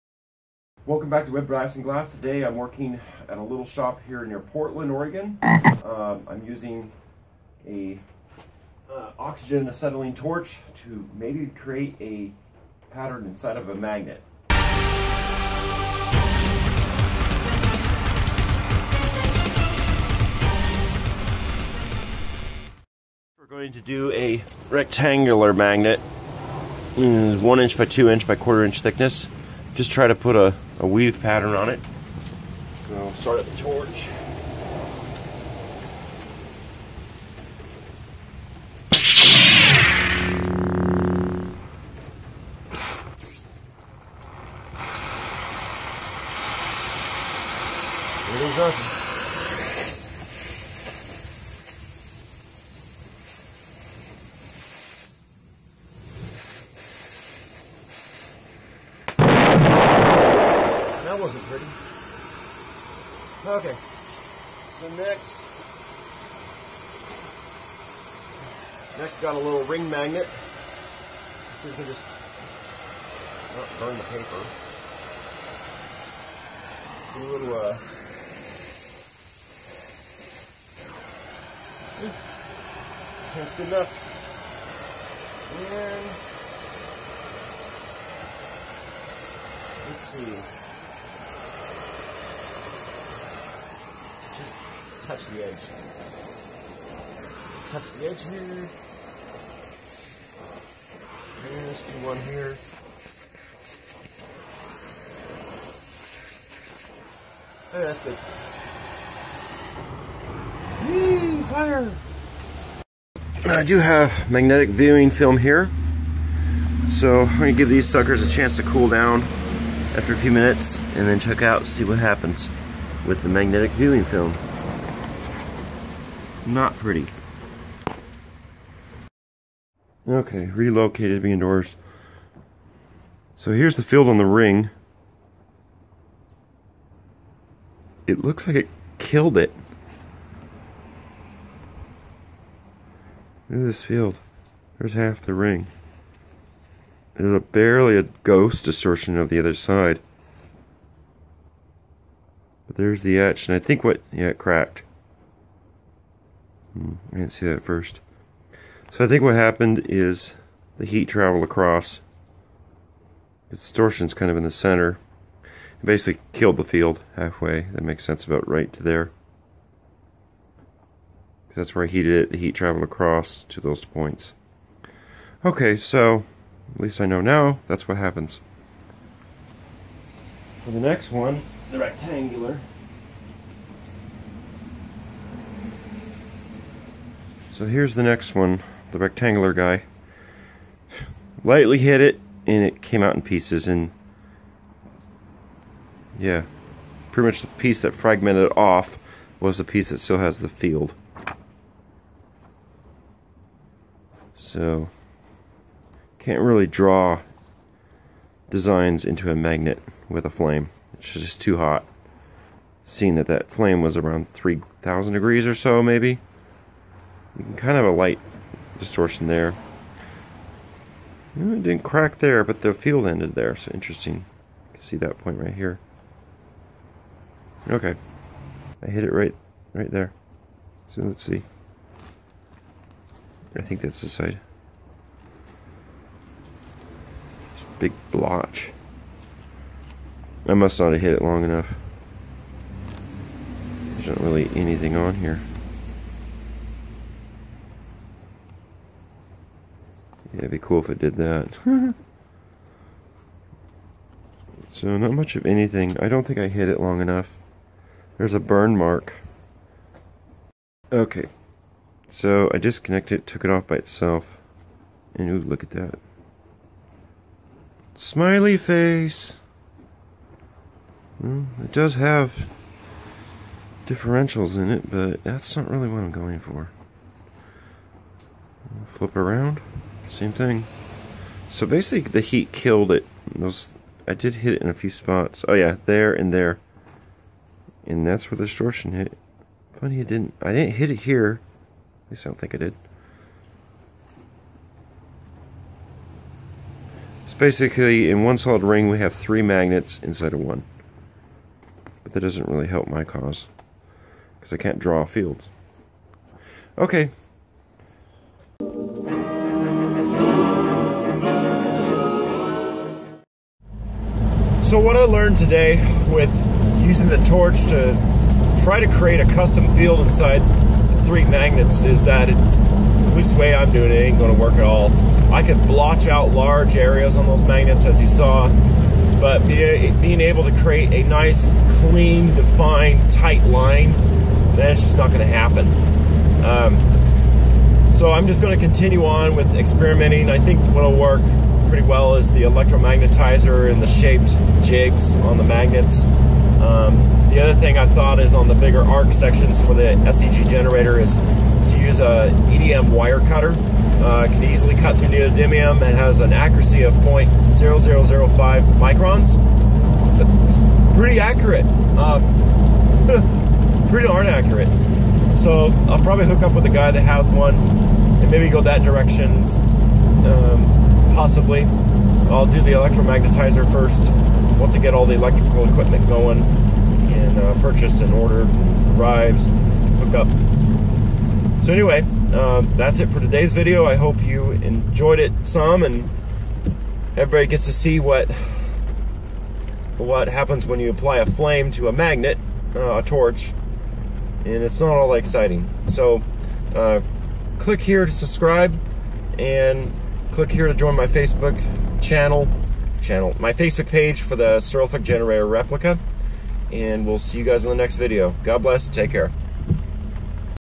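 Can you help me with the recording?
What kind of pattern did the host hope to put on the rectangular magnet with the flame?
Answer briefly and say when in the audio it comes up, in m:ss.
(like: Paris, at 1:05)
Weave pattern, at 0:30.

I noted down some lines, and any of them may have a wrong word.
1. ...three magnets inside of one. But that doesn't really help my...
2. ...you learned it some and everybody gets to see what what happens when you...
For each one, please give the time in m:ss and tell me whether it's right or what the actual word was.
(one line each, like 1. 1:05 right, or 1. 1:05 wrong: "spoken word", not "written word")
1. 4:59 right
2. 6:24 wrong: "enjoyed", not "learned".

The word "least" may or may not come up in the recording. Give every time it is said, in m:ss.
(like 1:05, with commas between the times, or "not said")
2:56, 4:52, 5:23.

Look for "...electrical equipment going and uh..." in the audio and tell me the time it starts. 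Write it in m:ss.
6:15.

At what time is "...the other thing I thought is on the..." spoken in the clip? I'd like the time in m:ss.
5:47.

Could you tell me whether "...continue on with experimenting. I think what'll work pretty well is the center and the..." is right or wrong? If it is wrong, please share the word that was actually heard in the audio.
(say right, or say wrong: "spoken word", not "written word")
wrong: "electromagnetizer", not "center".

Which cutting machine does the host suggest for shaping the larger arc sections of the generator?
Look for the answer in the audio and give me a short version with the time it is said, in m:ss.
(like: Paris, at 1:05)
EDM wire cutter, at 5:52.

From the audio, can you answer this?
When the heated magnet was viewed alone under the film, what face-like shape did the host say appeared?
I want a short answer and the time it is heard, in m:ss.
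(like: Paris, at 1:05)
Smiley face, at 4:27.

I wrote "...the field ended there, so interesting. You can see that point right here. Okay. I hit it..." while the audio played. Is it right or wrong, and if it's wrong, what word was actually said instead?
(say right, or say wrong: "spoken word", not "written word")
right.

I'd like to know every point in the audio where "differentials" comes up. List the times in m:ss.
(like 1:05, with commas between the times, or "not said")
4:33.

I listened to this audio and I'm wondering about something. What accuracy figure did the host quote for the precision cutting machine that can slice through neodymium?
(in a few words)
0.0005 microns.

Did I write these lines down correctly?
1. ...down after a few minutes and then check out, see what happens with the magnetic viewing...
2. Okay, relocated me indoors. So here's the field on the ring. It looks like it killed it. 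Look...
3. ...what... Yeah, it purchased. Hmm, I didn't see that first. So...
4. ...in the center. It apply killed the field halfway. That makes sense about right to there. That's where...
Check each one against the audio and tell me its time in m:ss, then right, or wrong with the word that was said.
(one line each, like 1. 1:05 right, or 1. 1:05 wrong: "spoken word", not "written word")
1. 1:58 right
2. 2:10 right
3. 2:33 wrong: "cracked", not "purchased"
4. 2:44 wrong: "basically", not "apply".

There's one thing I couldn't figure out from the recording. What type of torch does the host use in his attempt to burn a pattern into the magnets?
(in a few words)
Oxygen acetylene torch.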